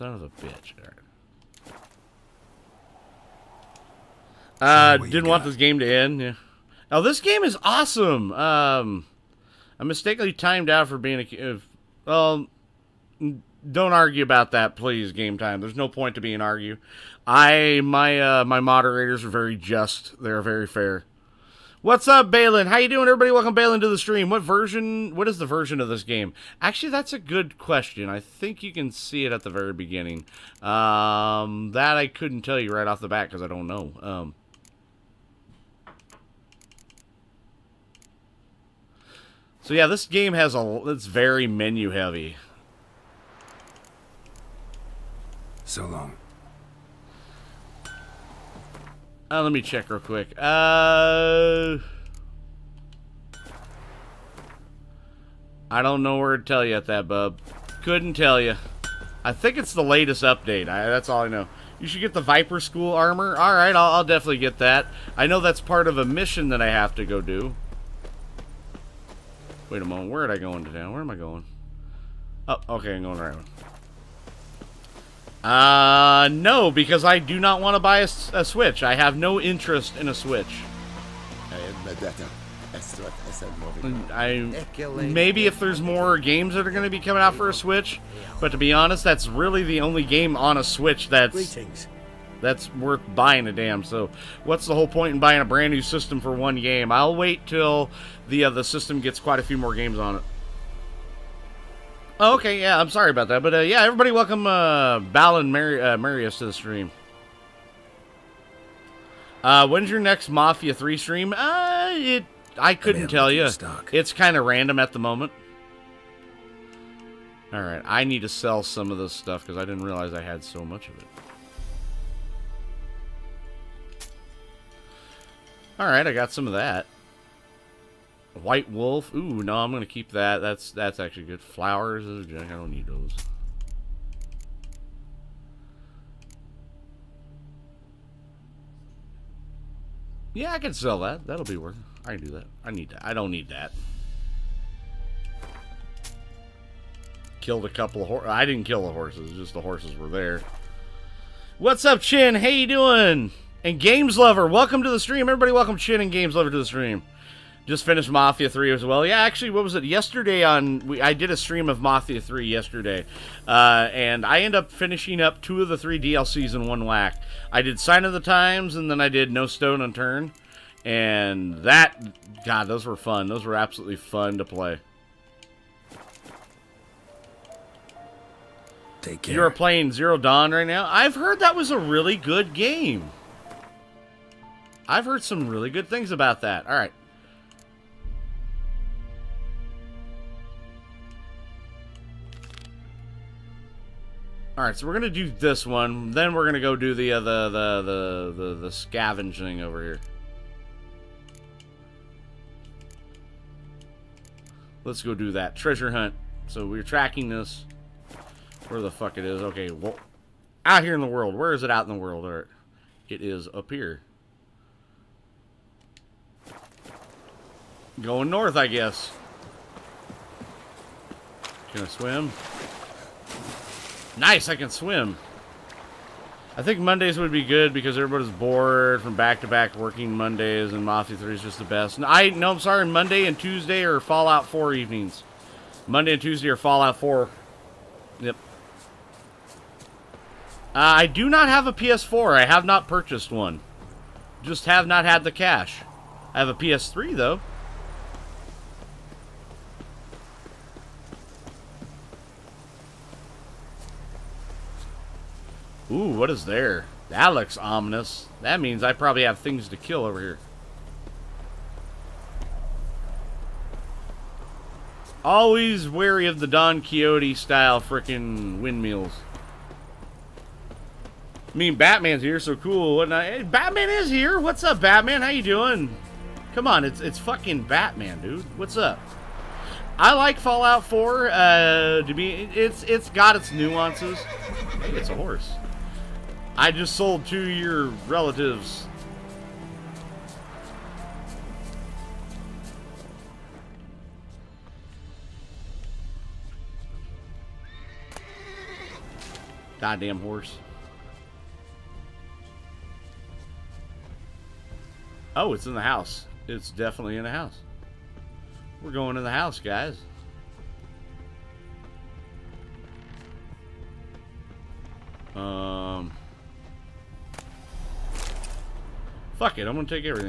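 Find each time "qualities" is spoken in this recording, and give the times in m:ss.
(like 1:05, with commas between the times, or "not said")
not said.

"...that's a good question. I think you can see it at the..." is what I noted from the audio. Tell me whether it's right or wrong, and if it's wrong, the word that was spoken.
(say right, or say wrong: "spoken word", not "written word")
right.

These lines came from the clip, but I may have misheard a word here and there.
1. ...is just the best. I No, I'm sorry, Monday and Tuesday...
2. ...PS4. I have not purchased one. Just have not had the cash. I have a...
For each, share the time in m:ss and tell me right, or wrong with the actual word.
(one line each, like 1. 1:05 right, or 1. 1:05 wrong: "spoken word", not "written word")
1. 3:51 right
2. 4:01 right.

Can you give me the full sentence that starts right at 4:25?
Always wary of the Don Quixote style freaking windmills.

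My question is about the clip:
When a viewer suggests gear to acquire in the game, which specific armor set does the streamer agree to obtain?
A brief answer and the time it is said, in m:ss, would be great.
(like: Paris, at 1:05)
Viper School armor, at 1:02.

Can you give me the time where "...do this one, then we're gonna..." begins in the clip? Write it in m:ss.
3:15.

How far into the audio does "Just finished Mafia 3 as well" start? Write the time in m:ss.
2:37.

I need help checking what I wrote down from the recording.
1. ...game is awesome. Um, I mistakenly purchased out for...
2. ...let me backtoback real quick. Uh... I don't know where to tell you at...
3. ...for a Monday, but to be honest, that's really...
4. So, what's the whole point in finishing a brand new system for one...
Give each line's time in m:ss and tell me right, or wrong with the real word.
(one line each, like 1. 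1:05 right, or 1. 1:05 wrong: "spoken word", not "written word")
1. 0:07 wrong: "timed", not "purchased"
2. 0:49 wrong: "check", not "backtoback"
3. 1:27 wrong: "Switch", not "Monday"
4. 1:33 wrong: "buying", not "finishing".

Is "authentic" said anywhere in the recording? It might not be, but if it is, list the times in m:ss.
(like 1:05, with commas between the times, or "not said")
not said.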